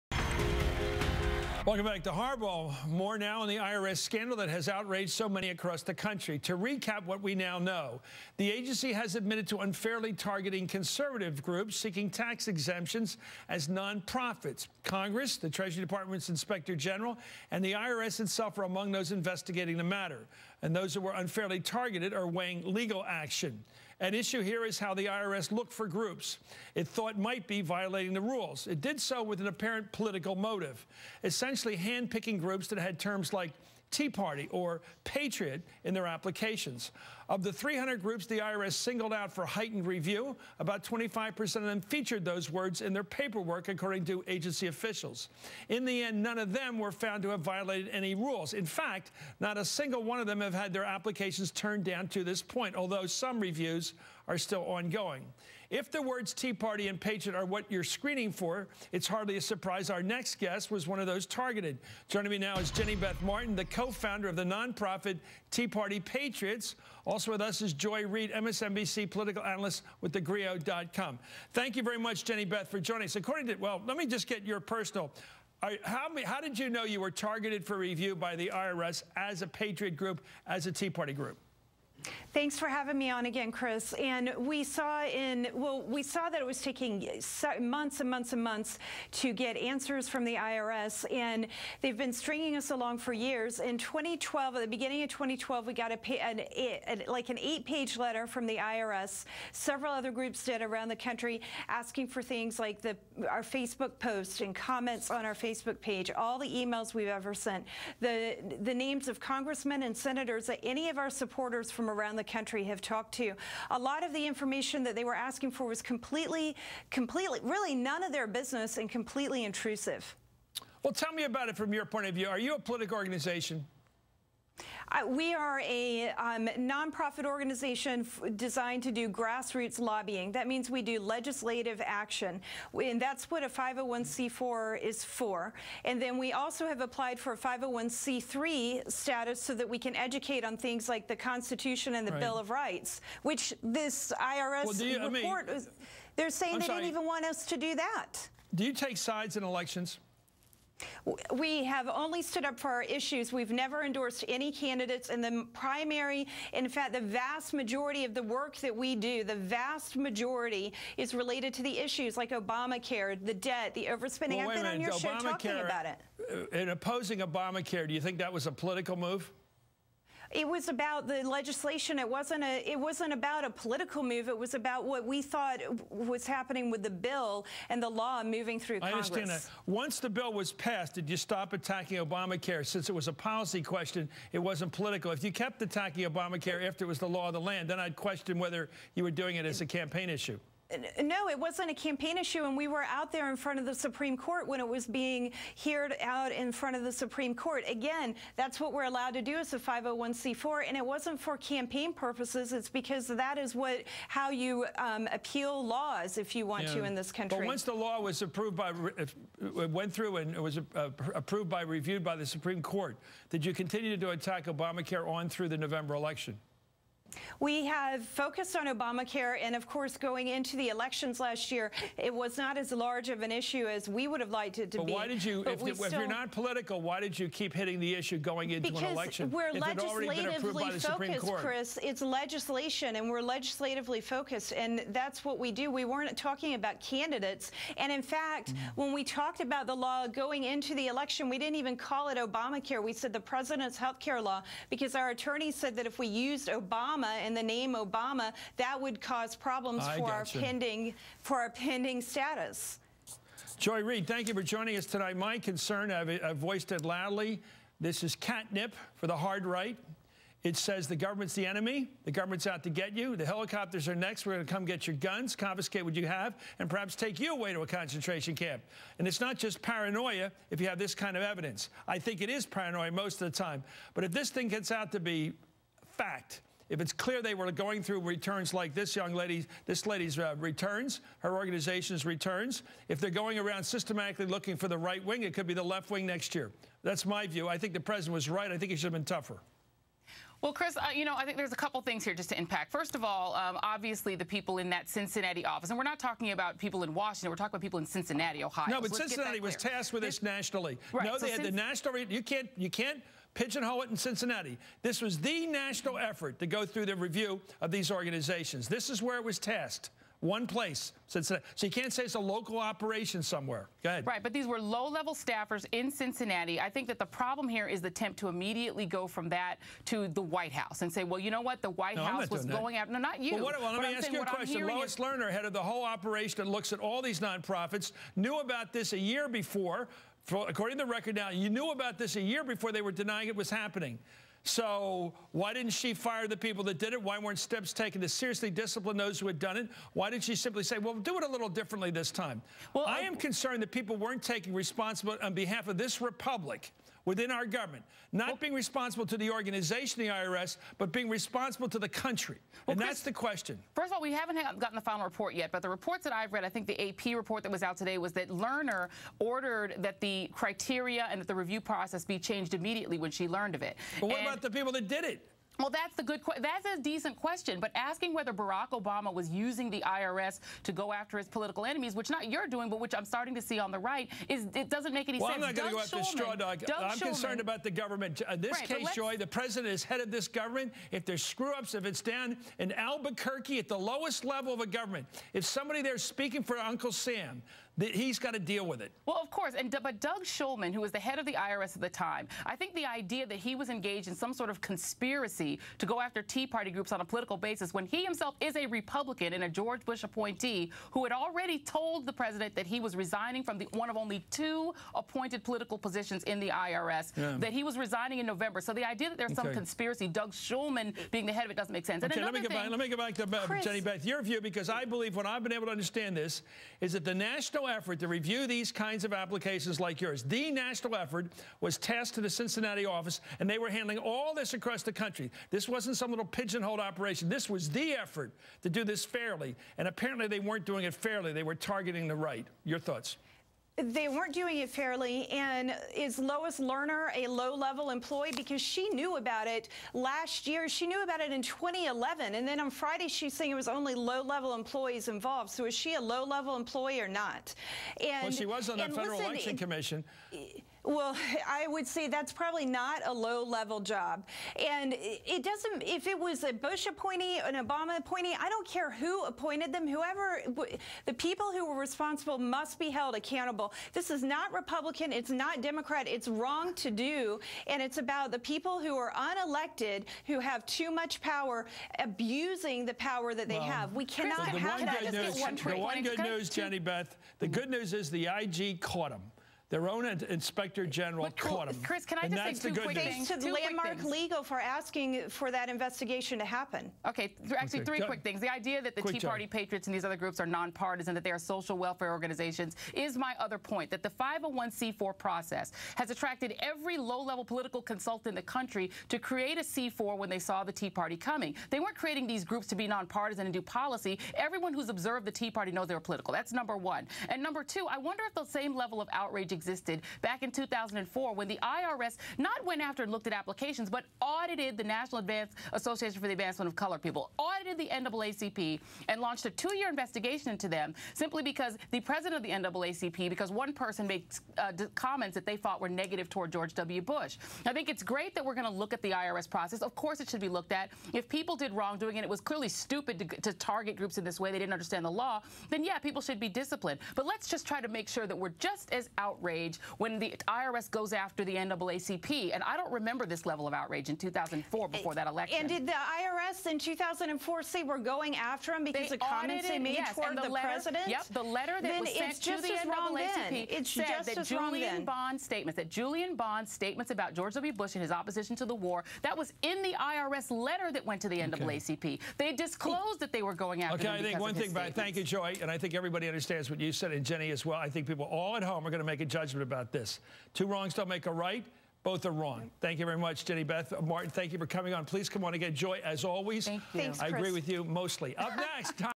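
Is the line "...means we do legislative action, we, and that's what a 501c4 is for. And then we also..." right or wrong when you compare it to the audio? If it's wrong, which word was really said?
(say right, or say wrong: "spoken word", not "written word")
right.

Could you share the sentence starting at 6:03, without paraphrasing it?
But what and about the people that did it?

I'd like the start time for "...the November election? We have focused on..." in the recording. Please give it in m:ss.
3:35.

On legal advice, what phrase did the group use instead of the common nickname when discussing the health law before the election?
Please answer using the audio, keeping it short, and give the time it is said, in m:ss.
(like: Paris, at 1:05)
the president's health care law, at 4:03.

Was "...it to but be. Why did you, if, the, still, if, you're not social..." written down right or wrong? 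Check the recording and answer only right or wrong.
wrong.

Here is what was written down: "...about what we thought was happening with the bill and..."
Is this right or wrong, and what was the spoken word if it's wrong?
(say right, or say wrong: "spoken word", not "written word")
right.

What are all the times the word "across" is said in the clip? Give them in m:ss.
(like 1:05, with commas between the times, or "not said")
0:05, 7:04.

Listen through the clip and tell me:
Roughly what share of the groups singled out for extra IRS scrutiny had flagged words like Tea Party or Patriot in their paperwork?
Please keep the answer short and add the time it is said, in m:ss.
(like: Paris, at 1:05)
25%, at 0:40.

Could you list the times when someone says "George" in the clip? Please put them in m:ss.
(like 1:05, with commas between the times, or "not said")
6:39, 8:46, 9:17.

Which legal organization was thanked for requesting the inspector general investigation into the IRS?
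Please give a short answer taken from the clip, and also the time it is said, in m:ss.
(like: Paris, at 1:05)
Landmark Legal, at 8:03.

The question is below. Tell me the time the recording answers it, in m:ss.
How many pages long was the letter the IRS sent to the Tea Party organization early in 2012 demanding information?
1:37.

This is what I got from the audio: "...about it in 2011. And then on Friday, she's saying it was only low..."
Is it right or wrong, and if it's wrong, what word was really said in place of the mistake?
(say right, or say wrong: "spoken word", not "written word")
right.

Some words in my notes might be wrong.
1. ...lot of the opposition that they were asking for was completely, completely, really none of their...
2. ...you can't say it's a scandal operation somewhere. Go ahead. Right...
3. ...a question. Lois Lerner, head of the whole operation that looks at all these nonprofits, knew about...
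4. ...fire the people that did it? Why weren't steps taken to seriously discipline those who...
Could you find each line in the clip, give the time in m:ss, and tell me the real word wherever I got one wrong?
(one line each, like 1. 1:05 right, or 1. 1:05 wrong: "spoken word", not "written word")
1. 1:53 wrong: "information", not "opposition"
2. 5:11 wrong: "local", not "scandal"
3. 5:24 right
4. 5:35 right.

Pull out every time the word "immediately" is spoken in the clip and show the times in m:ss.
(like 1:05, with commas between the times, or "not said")
5:18, 6:02.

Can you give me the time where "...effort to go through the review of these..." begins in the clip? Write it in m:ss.
5:05.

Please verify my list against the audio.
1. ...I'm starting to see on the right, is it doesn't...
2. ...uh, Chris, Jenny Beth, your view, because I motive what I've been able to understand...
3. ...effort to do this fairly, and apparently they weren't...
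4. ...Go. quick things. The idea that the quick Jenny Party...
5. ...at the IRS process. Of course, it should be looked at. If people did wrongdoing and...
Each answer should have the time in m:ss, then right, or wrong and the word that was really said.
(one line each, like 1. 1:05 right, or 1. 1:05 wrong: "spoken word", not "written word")
1. 6:12 right
2. 6:53 wrong: "believe", not "motive"
3. 7:07 right
4. 8:07 wrong: "Tea", not "Jenny"
5. 8:48 right.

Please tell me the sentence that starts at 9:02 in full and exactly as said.
And I don't remember this level of outrage in 2004 before that election.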